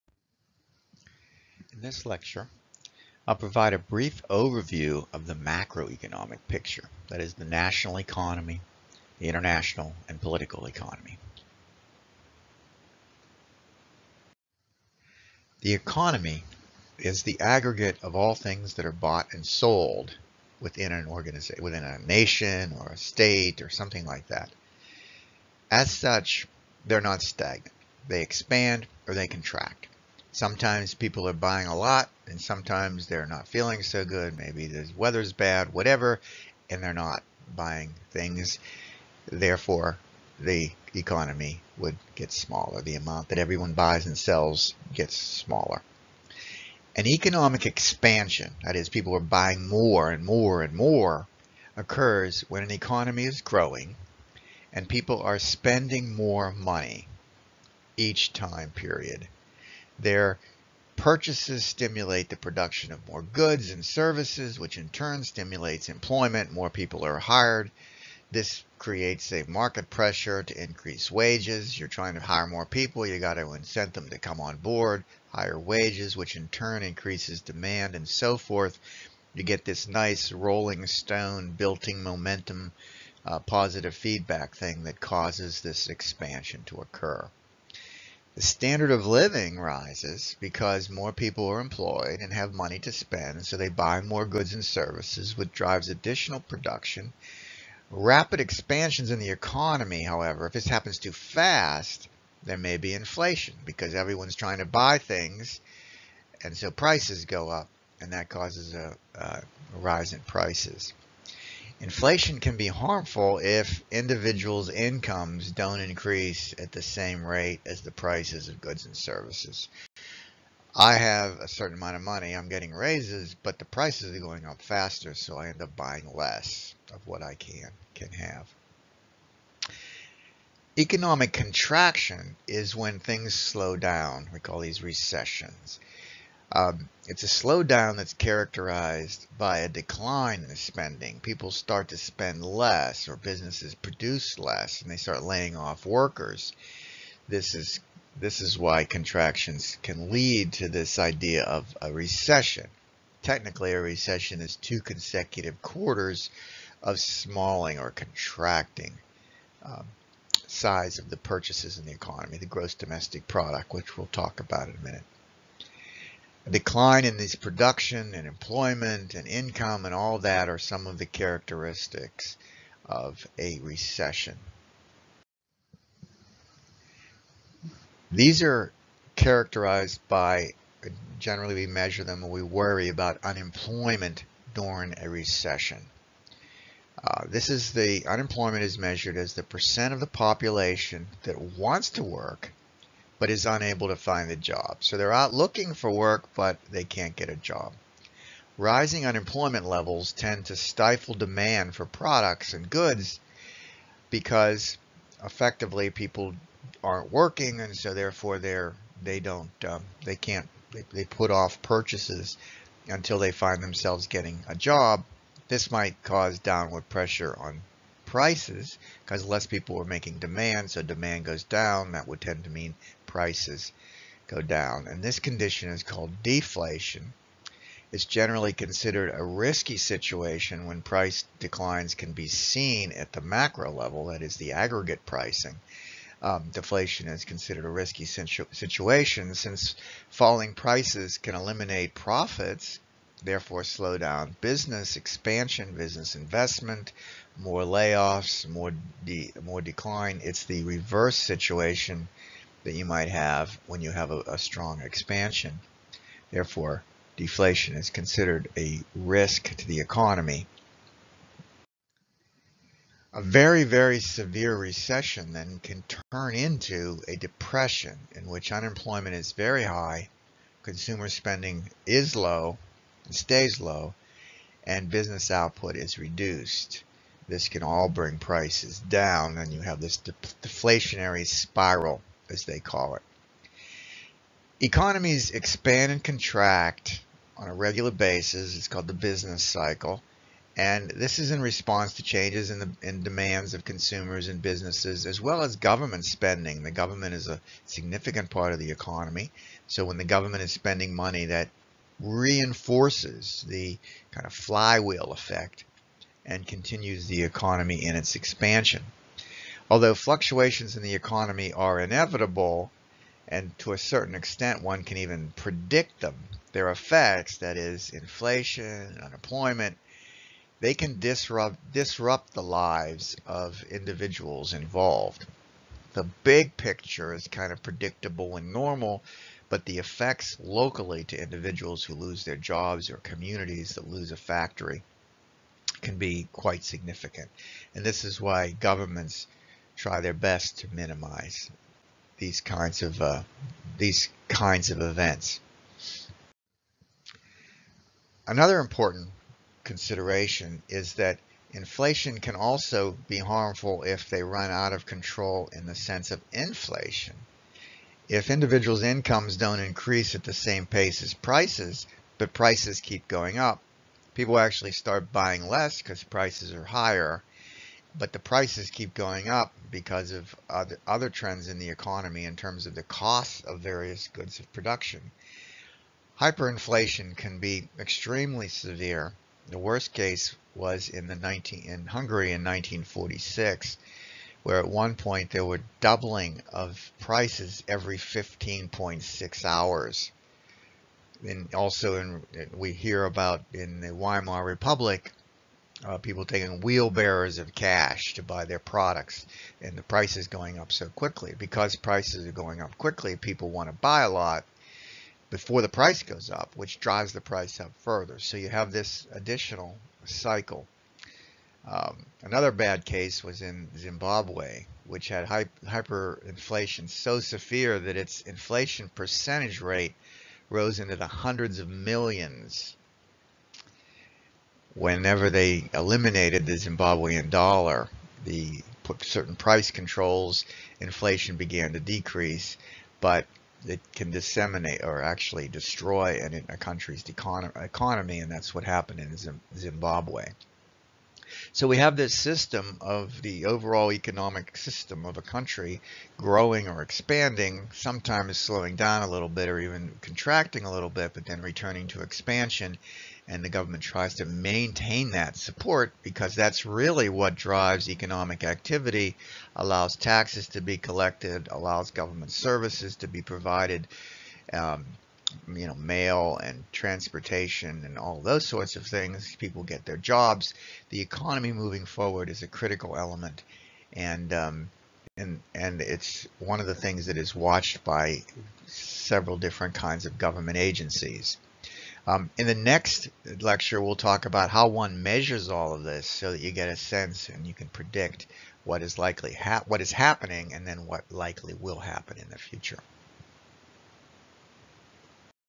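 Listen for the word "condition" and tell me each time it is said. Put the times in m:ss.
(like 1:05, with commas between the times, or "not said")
3:45.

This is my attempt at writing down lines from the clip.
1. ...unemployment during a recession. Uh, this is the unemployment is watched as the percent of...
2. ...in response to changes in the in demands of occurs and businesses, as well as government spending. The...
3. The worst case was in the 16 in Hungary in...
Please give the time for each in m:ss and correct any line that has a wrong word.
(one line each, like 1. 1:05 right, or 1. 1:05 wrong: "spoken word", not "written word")
1. 3:03 wrong: "measured", not "watched"
2. 4:51 wrong: "consumers", not "occurs"
3. 6:19 wrong: "19", not "16".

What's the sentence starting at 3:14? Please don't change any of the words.
So they're out looking for work, but they can't get a job.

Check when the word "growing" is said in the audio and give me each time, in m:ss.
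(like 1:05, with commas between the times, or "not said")
0:53, 7:26.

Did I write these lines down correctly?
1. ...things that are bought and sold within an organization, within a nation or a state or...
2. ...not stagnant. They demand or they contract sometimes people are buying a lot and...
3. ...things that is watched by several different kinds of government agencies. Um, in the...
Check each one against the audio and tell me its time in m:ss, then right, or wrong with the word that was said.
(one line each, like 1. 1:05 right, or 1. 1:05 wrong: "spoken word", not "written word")
1. 0:18 right
2. 0:27 wrong: "expand", not "demand"
3. 7:56 right.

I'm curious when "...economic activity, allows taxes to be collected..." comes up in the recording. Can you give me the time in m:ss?
7:37.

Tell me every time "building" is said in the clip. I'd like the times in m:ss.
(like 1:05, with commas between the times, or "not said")
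1:21.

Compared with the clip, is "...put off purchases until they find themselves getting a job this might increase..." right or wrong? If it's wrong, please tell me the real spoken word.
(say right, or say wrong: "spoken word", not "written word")
wrong: "cause", not "increase".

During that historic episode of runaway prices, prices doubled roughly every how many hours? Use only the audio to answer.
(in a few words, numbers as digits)
15.6 hours.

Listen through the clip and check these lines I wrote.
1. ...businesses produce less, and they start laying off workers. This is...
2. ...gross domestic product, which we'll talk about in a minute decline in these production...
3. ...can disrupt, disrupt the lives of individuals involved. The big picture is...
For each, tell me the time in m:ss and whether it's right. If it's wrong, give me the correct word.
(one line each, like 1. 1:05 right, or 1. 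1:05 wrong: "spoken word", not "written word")
1. 2:23 right
2. 2:42 right
3. 5:20 right.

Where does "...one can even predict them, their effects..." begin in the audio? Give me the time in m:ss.
5:14.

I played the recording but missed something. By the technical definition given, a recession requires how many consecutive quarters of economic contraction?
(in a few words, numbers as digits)
2.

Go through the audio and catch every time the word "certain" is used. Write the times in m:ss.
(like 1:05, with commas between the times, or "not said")
2:01, 5:13, 7:09.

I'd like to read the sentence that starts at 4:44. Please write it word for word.
Economies expand and contract on a regular basis.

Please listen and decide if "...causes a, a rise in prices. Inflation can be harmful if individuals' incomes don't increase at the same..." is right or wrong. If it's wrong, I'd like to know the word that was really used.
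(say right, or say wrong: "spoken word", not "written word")
right.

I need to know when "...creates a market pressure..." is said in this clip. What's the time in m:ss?
1:08.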